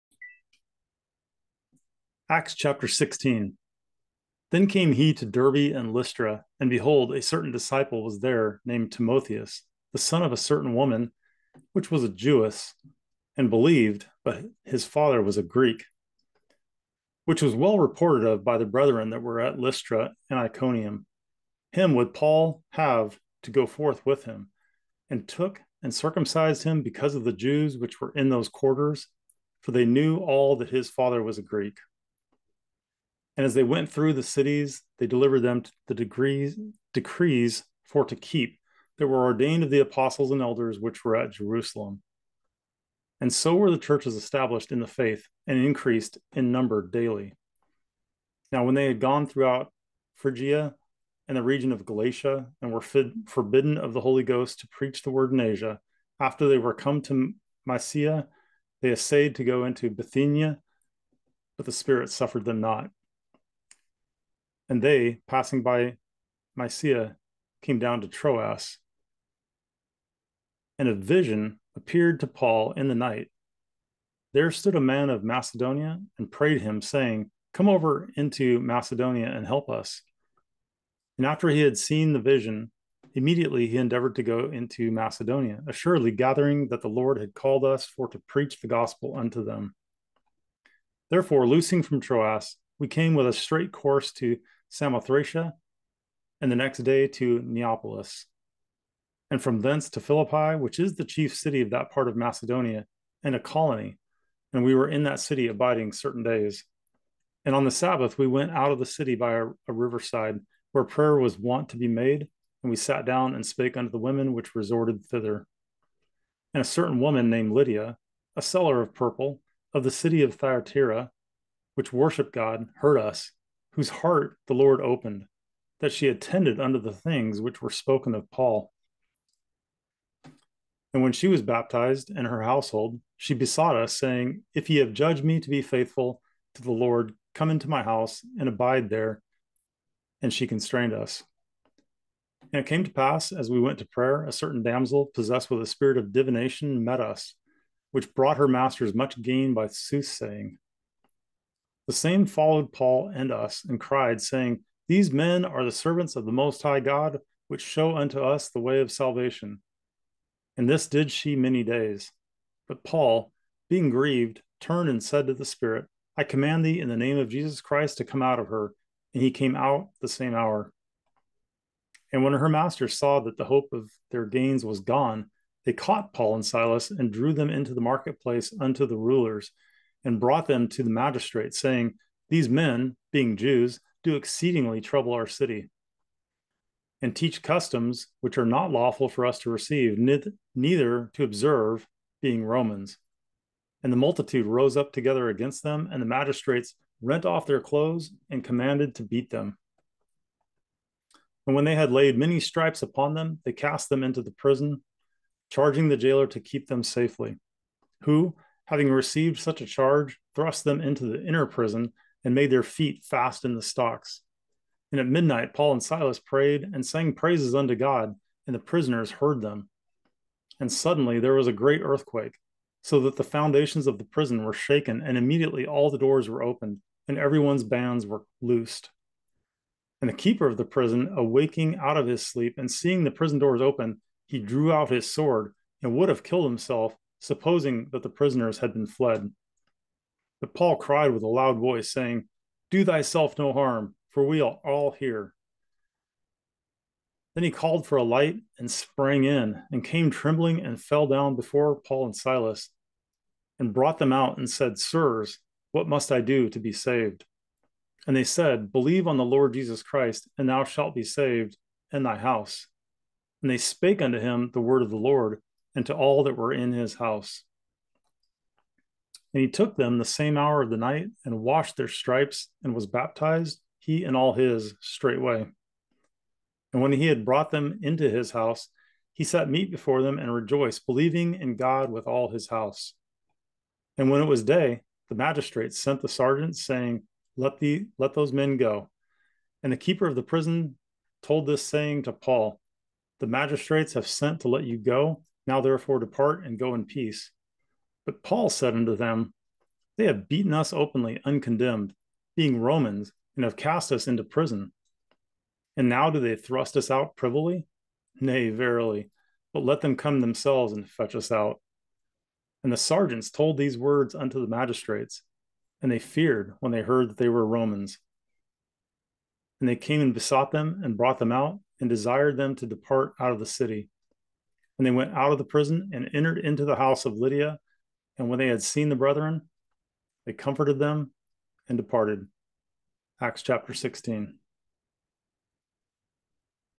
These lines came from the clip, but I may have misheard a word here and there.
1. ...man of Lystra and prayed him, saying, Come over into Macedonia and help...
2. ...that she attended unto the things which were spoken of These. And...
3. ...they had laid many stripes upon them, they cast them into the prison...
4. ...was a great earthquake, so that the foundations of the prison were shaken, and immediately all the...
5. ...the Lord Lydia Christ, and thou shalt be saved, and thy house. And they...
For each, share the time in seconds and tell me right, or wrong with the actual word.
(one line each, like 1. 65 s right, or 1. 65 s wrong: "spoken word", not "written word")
1. 74 s wrong: "Macedonia", not "Lystra"
2. 125 s wrong: "Paul", not "These"
3. 201 s right
4. 221 s right
5. 259 s wrong: "Jesus", not "Lydia".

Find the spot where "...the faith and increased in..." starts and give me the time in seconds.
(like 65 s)
44 s.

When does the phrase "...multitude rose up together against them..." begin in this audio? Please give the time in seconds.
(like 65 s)
193 s.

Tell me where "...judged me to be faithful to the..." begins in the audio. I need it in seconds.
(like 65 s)
134 s.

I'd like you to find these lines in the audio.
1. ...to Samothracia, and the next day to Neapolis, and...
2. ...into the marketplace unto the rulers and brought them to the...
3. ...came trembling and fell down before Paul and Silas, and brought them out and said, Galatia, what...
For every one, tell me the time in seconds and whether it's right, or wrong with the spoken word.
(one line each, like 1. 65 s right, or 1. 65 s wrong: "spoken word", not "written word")
1. 94 s right
2. 177 s right
3. 249 s wrong: "Sirs", not "Galatia".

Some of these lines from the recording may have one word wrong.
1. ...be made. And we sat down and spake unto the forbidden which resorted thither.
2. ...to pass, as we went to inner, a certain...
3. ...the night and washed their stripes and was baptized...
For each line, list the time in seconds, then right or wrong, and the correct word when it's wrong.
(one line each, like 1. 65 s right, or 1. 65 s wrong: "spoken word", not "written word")
1. 111 s wrong: "women", not "forbidden"
2. 142 s wrong: "prayer", not "inner"
3. 270 s right.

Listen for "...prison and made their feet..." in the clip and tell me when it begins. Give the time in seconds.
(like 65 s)
211 s.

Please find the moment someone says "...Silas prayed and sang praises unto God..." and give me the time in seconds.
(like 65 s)
215 s.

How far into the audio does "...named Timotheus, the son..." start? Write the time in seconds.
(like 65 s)
8 s.